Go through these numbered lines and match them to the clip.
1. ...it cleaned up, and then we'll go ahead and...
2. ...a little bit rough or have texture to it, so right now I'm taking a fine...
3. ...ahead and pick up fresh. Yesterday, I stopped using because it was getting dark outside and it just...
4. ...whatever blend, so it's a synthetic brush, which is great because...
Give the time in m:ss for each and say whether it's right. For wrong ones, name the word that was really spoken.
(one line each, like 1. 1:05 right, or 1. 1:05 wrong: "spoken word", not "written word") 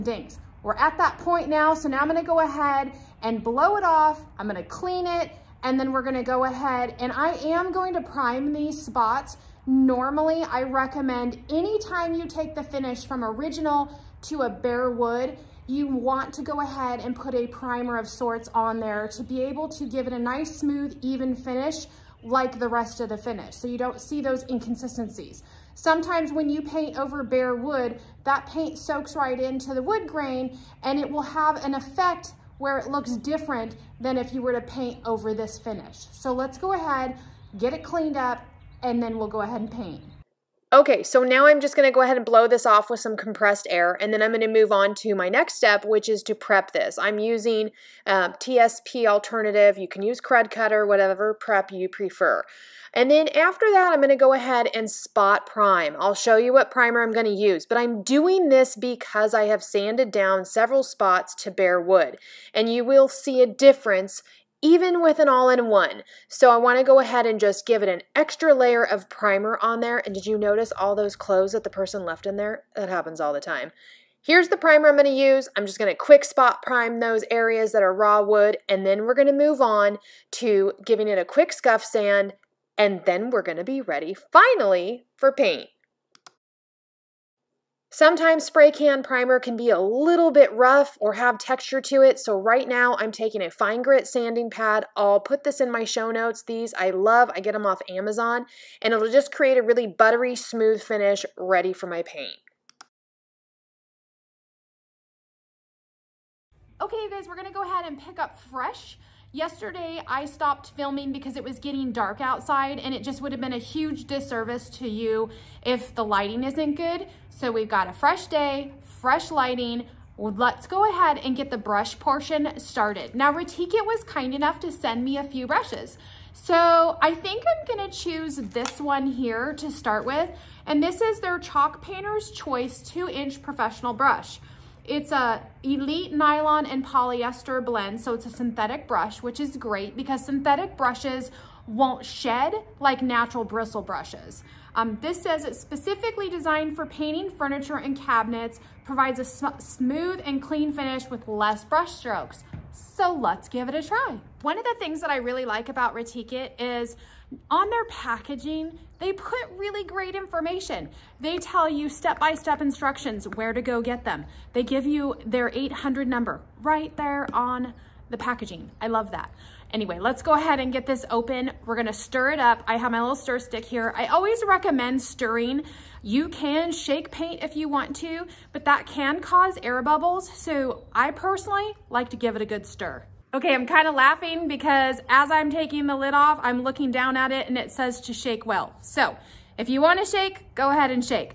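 1. 0:37 right
2. 1:29 right
3. 1:47 wrong: "filming", not "using"
4. 2:16 wrong: "polyester", not "whatever".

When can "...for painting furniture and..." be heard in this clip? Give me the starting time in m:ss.
2:26.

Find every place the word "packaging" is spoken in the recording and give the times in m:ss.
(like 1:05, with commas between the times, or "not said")
2:37, 2:48.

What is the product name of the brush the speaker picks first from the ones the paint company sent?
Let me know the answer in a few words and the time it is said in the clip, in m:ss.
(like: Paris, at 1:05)
Chalk Painter's Choice, at 2:11.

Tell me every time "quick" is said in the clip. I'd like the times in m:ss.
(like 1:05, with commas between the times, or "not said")
1:15, 1:21.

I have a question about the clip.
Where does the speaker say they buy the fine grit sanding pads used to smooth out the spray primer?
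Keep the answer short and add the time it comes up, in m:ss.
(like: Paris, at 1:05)
Amazon, at 1:37.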